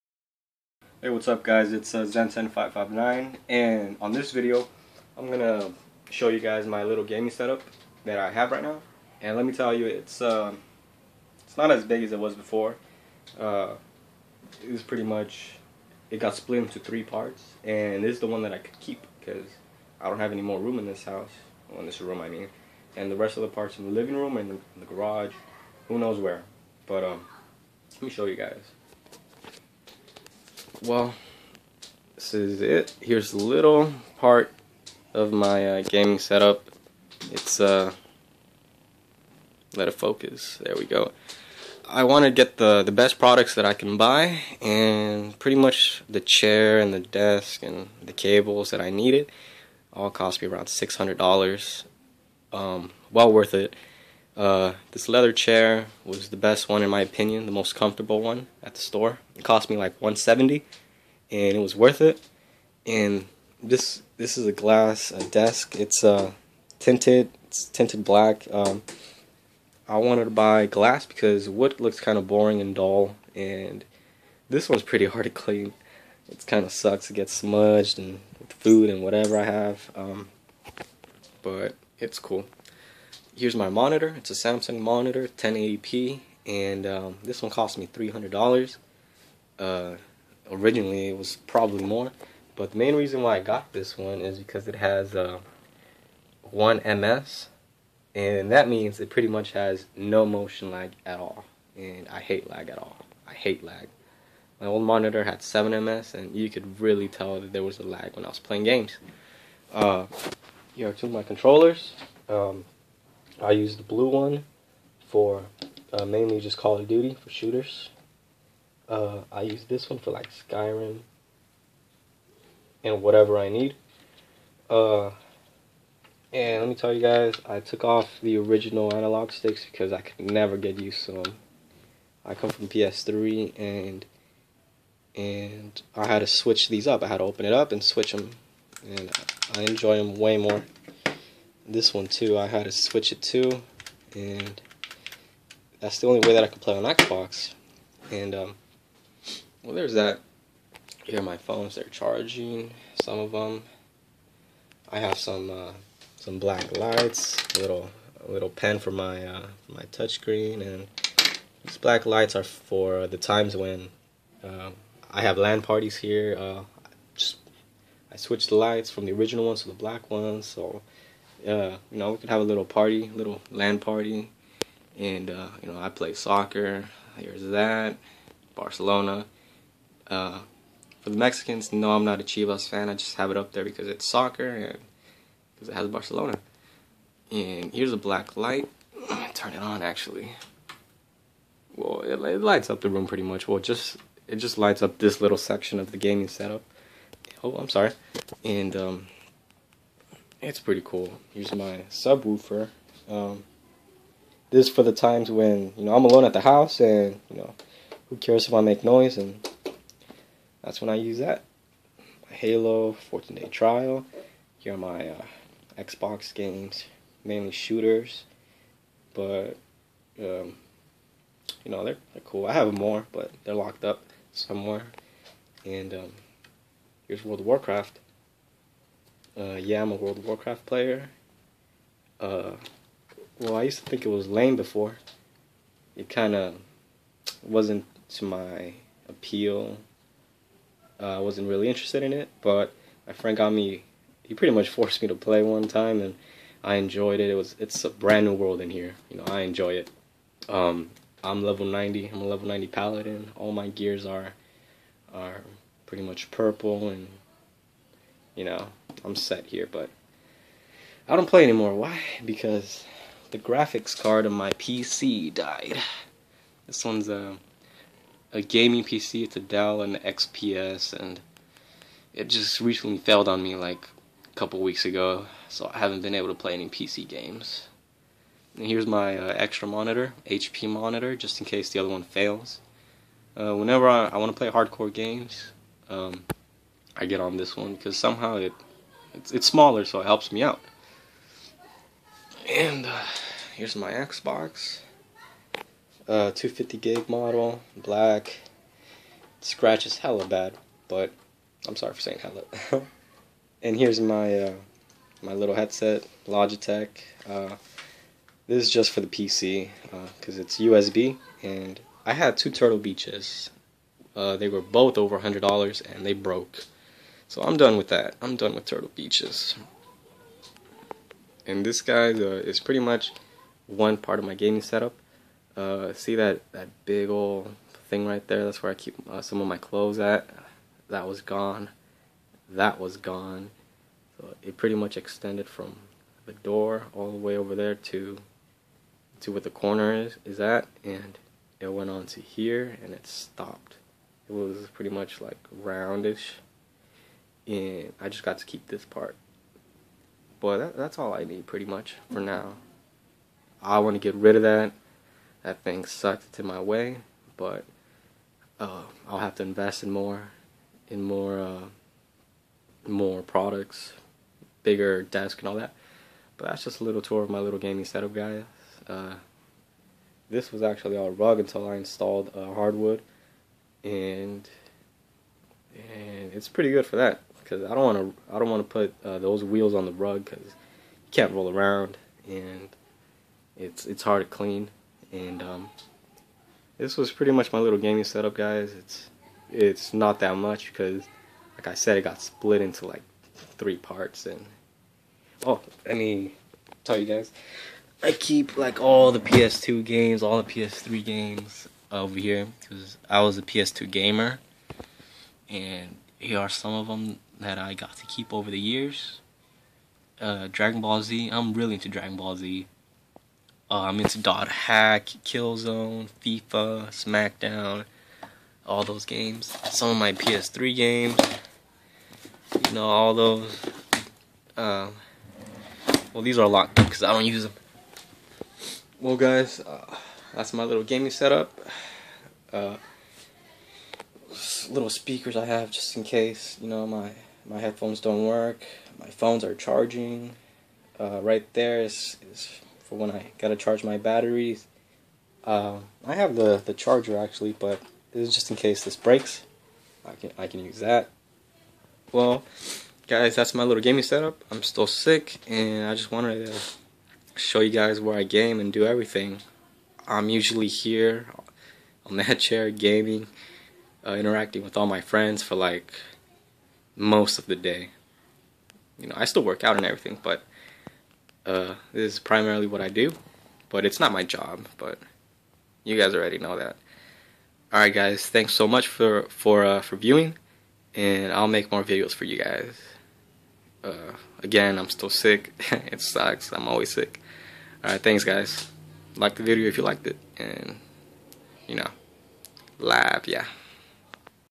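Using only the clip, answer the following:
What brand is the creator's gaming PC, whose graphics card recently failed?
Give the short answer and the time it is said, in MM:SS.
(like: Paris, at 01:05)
Dell, at 04:29.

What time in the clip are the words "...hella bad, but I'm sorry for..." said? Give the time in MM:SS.
04:59.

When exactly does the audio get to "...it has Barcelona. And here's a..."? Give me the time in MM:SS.
03:05.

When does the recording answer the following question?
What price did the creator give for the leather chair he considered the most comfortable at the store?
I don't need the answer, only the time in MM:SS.
01:00.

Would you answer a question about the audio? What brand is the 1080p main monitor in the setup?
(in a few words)
Samsung.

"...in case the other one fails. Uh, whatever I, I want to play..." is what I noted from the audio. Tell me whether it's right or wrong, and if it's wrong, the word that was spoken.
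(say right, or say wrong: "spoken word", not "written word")
wrong: "whenever", not "whatever".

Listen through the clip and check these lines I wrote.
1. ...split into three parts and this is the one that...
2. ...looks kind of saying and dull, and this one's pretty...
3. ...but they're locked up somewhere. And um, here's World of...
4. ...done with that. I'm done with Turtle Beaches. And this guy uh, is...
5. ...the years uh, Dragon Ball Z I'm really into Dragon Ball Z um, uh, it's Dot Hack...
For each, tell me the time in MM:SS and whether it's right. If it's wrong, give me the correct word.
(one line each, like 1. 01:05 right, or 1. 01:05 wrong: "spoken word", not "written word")
1. 00:16 right
2. 01:11 wrong: "boring", not "saying"
3. 03:43 right
4. 05:17 right
5. 06:48 right.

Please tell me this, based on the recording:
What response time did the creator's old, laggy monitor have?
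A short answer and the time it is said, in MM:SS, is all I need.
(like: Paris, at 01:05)
7 ms, at 01:45.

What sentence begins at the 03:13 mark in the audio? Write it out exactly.
Well, just it just lights up this little section of the gaming setup.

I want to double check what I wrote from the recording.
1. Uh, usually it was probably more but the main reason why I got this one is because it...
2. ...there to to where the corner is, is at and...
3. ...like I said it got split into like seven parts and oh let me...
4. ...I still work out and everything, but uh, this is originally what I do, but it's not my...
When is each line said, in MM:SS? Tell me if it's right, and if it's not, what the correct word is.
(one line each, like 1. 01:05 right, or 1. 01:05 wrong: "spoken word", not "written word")
1. 01:29 wrong: "originally", not "usually"
2. 05:37 right
3. 06:31 wrong: "three", not "seven"
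4. 07:49 wrong: "primarily", not "originally".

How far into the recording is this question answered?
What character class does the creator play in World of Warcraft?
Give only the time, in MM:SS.
04:12.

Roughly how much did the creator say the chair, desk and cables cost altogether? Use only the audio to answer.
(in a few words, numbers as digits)
$600.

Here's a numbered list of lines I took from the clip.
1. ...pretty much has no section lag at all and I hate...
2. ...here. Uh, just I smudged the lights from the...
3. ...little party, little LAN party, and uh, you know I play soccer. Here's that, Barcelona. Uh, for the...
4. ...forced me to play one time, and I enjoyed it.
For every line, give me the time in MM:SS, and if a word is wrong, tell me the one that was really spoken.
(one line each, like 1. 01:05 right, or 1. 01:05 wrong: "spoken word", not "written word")
1. 01:39 wrong: "motion", not "section"
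2. 02:45 wrong: "switched", not "smudged"
3. 02:52 right
4. 04:04 right.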